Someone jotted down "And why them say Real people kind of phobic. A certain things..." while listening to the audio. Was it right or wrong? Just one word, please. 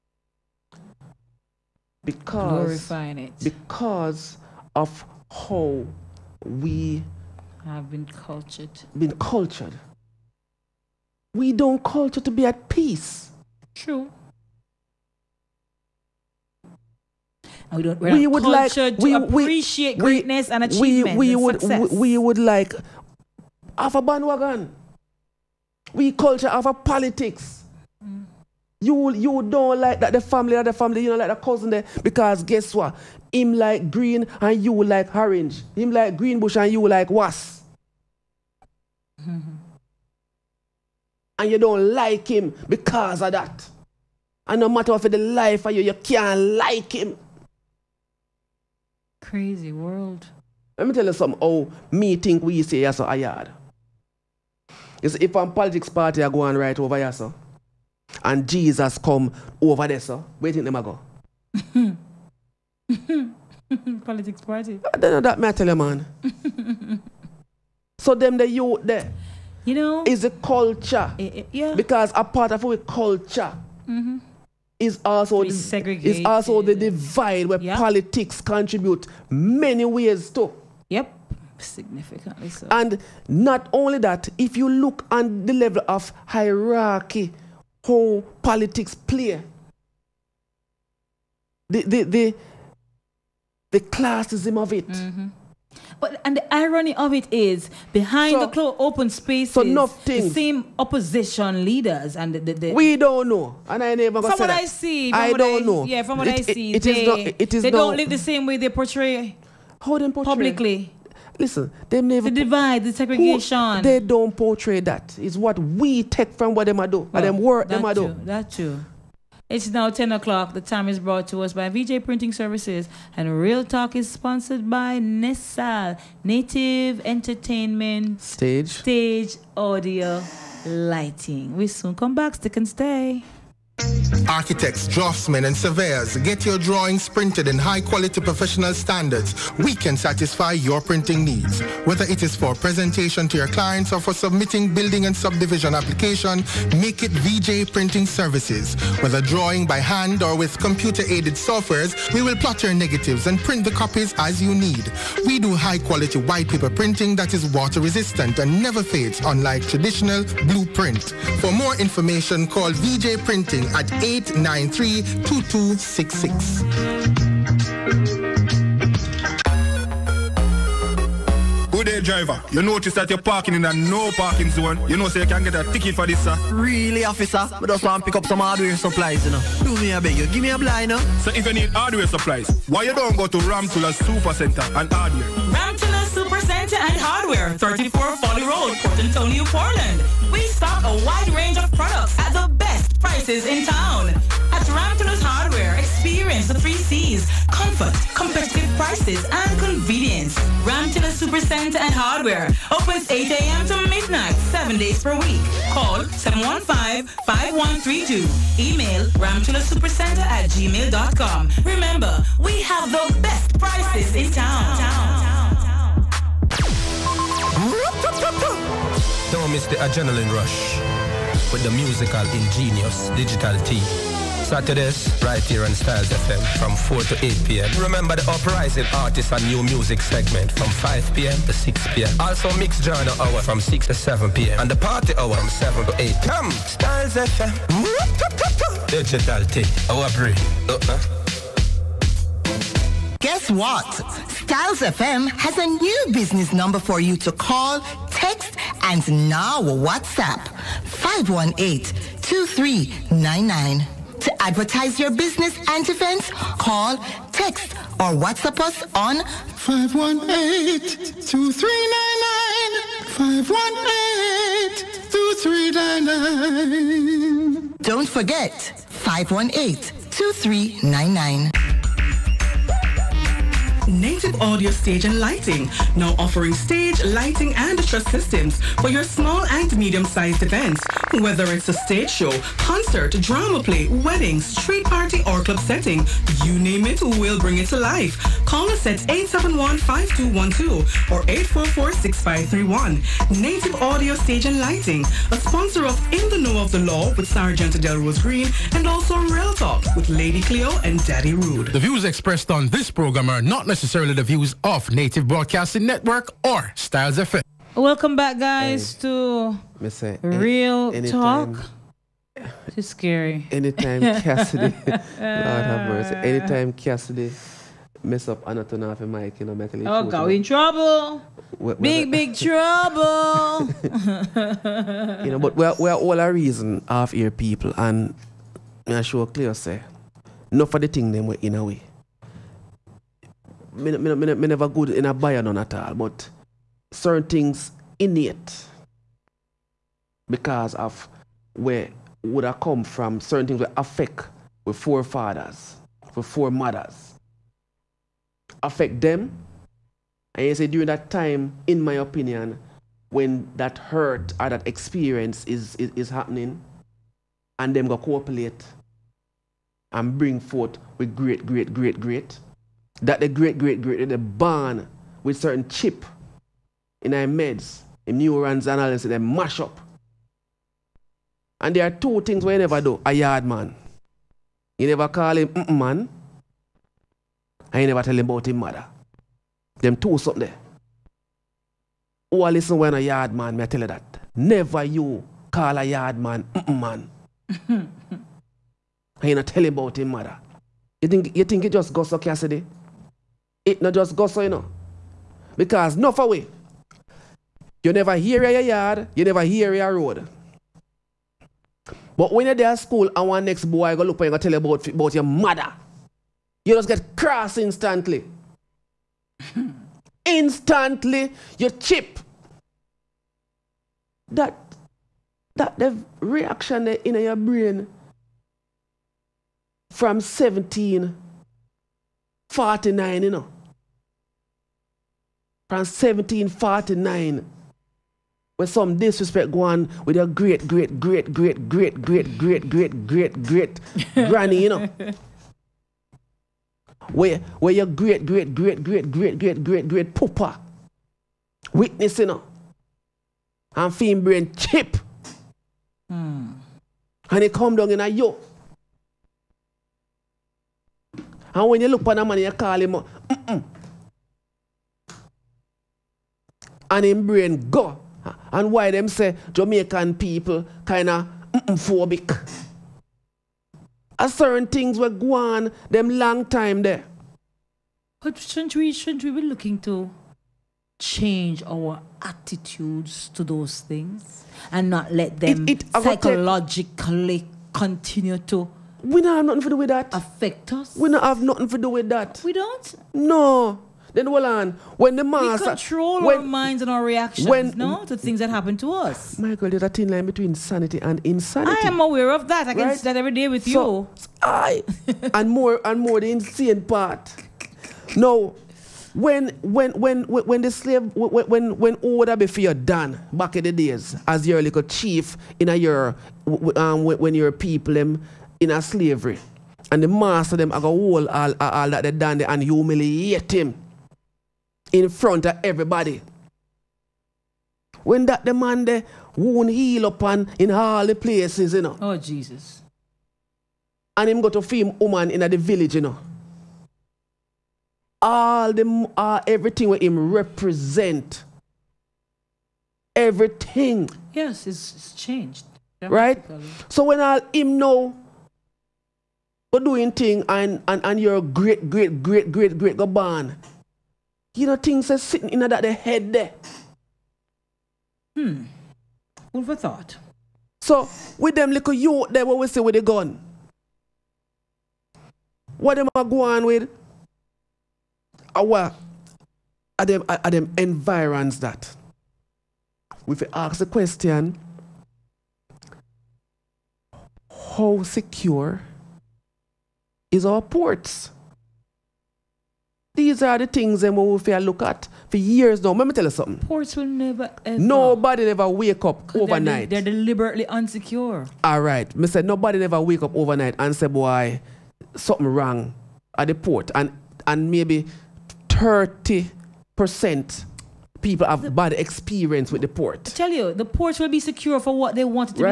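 wrong.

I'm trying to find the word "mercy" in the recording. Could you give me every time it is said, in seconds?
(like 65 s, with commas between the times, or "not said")
315 s.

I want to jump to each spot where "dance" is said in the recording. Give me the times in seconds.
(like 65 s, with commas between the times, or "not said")
not said.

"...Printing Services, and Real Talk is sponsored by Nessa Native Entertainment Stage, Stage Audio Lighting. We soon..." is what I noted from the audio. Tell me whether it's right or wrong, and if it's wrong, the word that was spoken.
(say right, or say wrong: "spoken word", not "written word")
right.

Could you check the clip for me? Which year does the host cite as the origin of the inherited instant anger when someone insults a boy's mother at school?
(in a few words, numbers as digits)
1749.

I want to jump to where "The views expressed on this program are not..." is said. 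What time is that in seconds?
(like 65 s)
301 s.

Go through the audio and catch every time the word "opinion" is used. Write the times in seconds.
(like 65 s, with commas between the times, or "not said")
351 s.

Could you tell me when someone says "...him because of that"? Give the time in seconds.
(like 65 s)
42 s.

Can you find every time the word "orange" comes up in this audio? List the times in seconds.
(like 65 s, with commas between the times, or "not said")
35 s.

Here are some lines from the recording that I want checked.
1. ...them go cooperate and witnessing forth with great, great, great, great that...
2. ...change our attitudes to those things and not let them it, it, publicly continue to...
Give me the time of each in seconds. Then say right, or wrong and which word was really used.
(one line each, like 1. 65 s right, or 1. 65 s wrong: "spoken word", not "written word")
1. 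357 s wrong: "bring", not "witnessing"
2. 470 s wrong: "psychologically", not "publicly".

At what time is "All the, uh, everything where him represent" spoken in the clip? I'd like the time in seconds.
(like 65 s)
528 s.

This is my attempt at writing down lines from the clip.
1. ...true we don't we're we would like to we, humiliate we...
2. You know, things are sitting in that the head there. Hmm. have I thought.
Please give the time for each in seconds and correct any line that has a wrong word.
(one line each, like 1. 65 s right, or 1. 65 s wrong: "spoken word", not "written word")
1. 13 s wrong: "appreciate", not "humiliate"
2. 544 s right.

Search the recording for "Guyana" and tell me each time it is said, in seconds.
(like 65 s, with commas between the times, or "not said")
not said.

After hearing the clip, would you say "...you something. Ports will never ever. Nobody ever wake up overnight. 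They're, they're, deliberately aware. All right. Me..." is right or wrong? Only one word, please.
wrong.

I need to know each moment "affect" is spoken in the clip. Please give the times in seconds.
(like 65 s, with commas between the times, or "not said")
343 s, 348 s, 480 s.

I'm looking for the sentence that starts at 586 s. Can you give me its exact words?
And, and maybe 30% people have the, bad experience with the port.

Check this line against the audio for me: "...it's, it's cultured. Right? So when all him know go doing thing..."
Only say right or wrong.
wrong.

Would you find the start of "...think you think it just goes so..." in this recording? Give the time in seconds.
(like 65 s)
391 s.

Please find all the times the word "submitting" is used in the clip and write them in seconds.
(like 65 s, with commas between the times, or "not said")
144 s.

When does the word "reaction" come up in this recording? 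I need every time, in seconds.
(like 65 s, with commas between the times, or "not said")
416 s, 487 s.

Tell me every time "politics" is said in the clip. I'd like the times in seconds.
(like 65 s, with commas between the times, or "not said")
26 s, 55 s, 64 s, 77 s, 88 s.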